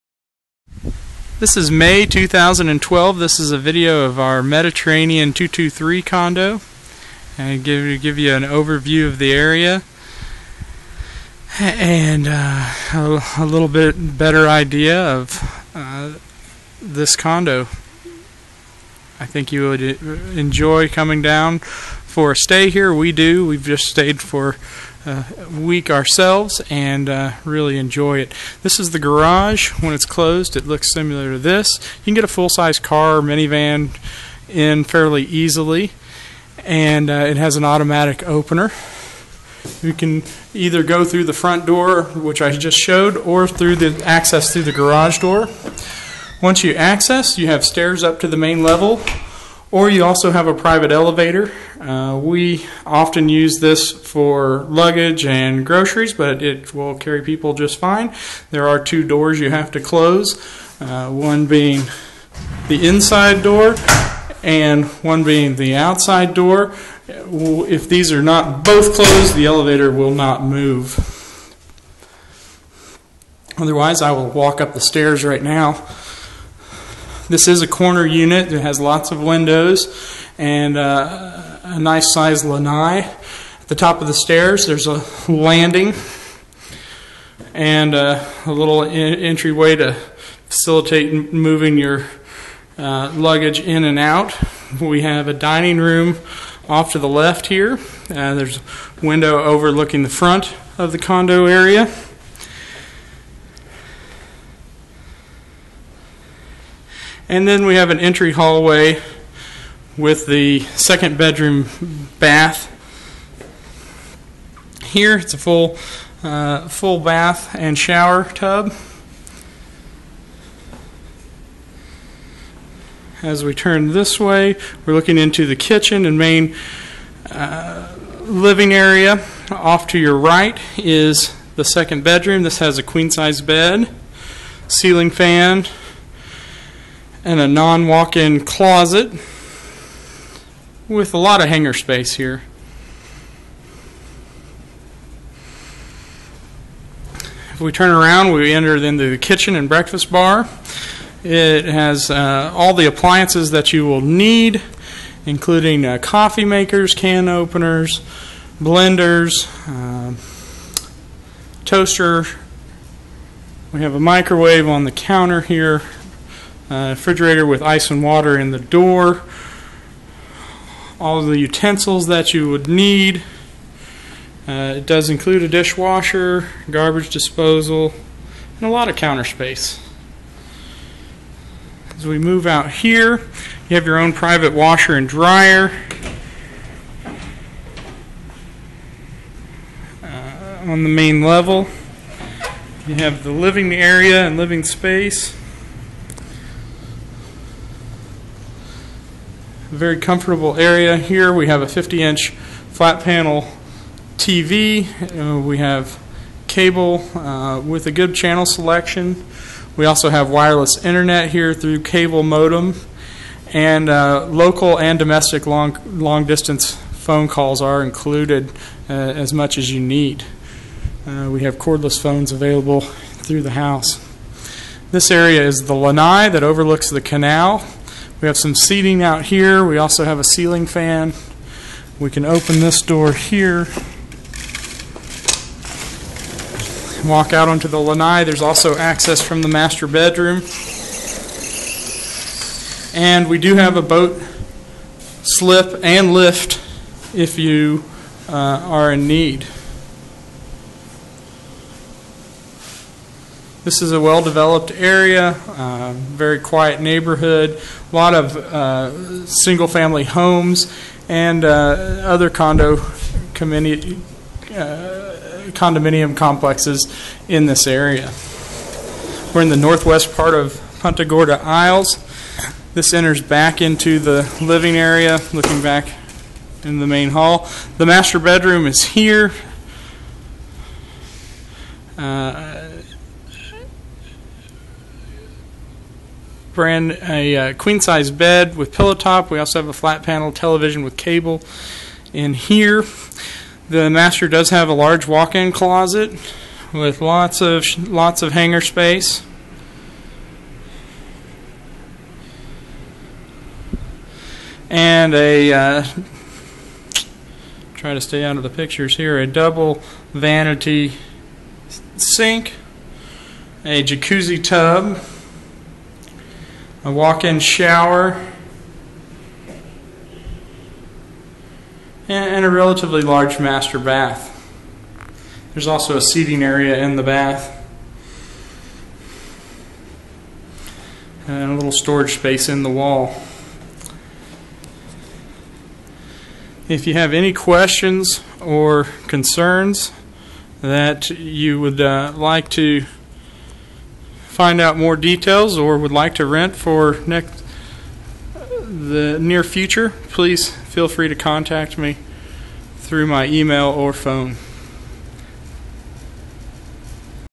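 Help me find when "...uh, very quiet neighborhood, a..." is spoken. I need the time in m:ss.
4:15.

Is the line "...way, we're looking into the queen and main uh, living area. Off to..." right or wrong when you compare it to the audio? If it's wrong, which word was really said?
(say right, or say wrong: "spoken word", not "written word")
wrong: "kitchen", not "queen".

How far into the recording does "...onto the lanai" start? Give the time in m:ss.
3:57.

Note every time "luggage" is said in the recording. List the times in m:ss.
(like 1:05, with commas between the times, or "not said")
0:54, 1:33.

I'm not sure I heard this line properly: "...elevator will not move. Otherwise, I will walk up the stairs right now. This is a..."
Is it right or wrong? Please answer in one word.
right.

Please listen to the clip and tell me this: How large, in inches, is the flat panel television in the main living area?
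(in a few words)
50-inch.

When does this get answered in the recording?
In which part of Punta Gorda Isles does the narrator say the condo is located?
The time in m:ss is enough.
4:29.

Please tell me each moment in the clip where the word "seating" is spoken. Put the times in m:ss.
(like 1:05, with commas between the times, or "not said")
3:48, 5:26.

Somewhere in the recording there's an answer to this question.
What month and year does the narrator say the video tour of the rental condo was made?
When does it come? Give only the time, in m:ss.
0:01.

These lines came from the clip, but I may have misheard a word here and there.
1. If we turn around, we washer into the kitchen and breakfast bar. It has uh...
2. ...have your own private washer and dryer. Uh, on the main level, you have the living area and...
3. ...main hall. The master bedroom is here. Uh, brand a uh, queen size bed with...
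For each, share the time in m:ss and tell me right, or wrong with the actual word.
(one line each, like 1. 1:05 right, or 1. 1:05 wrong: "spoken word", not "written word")
1. 2:27 wrong: "enter", not "washer"
2. 3:03 right
3. 4:36 right.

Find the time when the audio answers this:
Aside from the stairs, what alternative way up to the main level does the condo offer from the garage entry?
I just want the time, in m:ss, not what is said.
0:50.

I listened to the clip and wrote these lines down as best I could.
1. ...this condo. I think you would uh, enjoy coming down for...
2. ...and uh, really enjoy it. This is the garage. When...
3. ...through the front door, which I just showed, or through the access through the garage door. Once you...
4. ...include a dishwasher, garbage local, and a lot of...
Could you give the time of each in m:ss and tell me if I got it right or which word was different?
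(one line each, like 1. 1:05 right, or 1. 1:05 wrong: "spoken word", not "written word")
1. 0:16 right
2. 0:26 right
3. 0:41 right
4. 2:55 wrong: "disposal", not "local".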